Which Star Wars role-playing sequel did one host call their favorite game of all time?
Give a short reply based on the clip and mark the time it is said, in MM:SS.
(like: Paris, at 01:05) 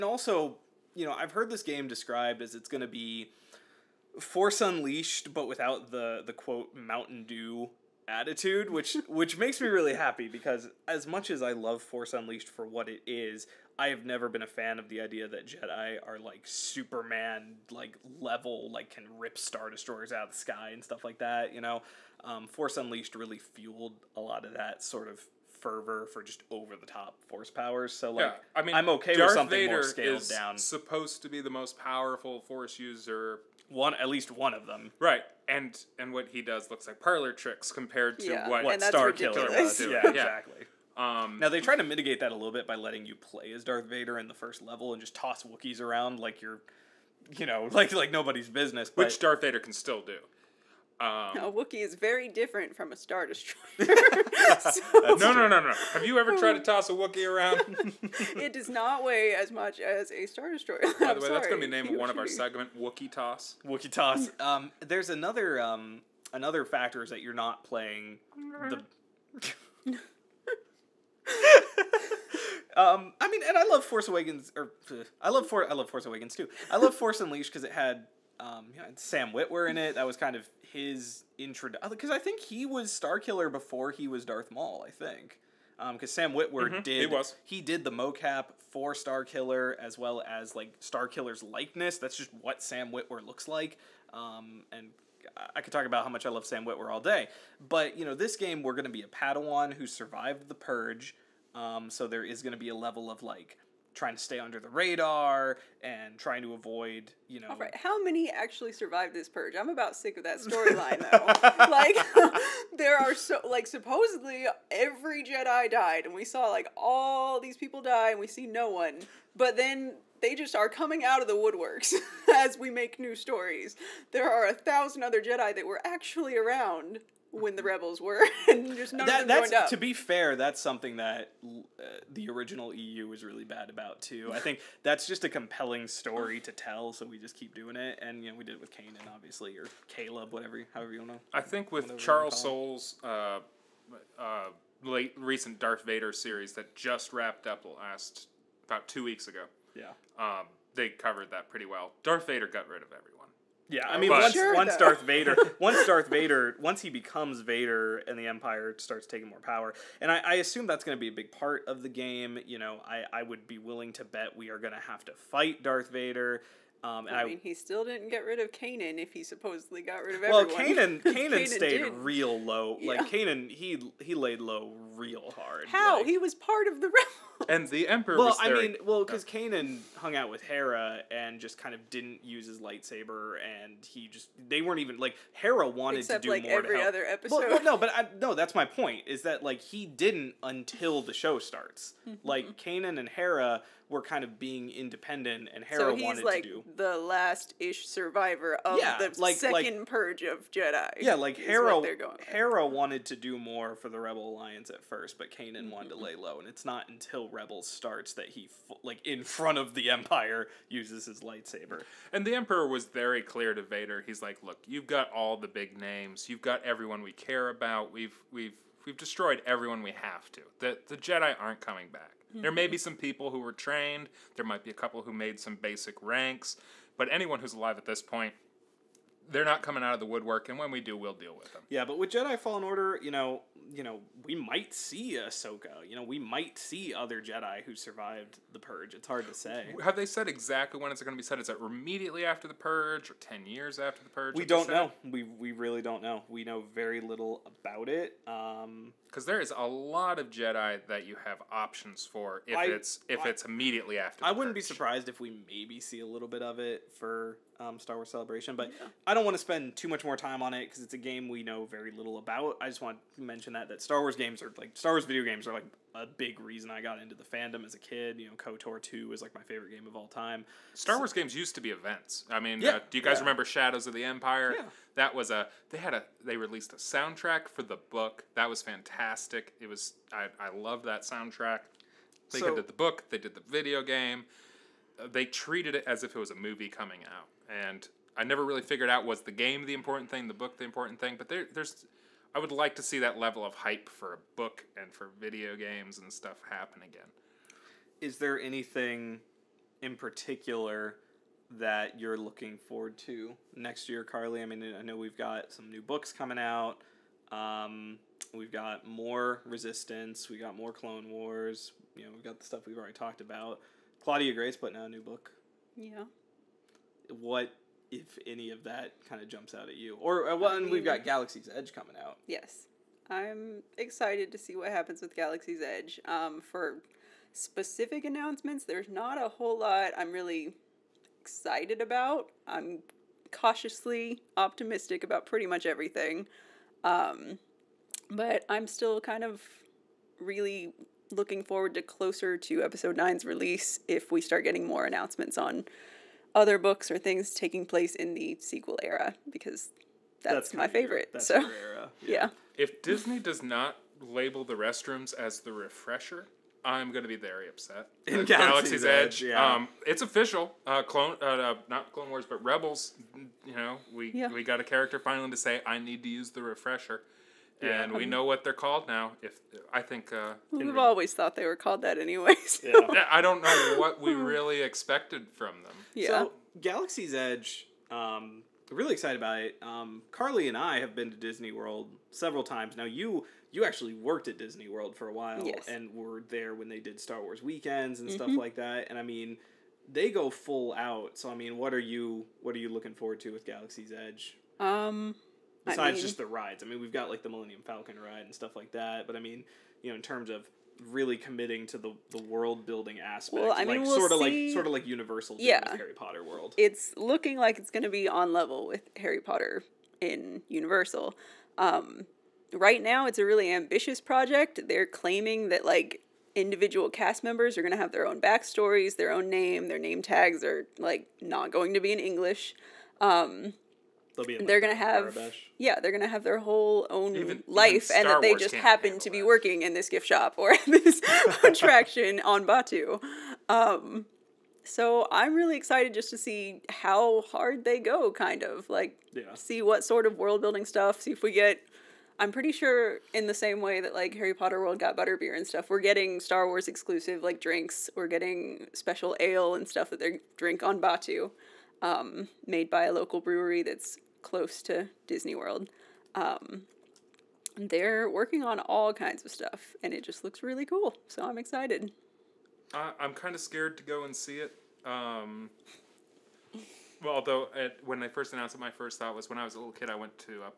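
KOTOR 2, at 04:28.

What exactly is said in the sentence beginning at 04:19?
I don't want to spend too much more time on it because it's a game we know very little about.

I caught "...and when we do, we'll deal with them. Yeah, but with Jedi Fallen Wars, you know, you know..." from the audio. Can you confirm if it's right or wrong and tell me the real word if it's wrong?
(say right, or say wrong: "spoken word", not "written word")
wrong: "Order", not "Wars".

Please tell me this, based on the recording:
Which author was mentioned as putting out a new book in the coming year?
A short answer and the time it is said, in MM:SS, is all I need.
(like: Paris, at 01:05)
Claudia Gray, at 05:14.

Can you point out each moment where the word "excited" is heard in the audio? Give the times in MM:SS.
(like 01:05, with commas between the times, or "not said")
05:23, 05:31, 06:18, 07:15, 07:41.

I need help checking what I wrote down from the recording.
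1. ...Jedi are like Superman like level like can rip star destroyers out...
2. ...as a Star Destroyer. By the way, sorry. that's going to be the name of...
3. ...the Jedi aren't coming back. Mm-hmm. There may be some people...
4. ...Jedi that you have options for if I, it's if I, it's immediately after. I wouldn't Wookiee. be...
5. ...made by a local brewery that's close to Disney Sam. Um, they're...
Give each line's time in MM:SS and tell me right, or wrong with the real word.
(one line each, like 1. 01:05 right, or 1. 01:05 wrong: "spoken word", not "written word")
1. 00:15 right
2. 00:59 right
3. 03:40 right
4. 04:10 wrong: "Purge", not "Wookiee"
5. 07:32 wrong: "World", not "Sam".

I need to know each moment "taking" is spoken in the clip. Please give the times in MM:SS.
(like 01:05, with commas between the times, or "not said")
02:39, 05:47.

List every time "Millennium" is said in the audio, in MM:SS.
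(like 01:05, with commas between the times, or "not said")
06:37.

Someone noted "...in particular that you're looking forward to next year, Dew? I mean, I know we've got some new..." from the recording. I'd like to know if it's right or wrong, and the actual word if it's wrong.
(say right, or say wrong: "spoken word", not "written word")
wrong: "Carly", not "Dew".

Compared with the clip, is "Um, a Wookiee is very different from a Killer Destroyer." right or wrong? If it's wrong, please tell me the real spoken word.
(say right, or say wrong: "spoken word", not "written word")
wrong: "Star", not "Killer".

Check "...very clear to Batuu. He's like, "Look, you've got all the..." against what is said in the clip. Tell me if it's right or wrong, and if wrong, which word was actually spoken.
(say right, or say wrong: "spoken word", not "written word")
wrong: "Vader", not "Batuu".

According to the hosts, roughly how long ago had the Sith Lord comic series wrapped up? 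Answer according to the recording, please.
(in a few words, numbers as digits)
about two weeks ago.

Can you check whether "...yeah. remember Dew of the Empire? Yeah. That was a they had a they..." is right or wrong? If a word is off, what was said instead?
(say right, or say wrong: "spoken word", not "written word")
wrong: "Shadows", not "Dew".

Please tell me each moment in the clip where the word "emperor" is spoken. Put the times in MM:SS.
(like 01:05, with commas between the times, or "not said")
02:57, 03:32.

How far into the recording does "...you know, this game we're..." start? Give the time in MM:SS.
01:37.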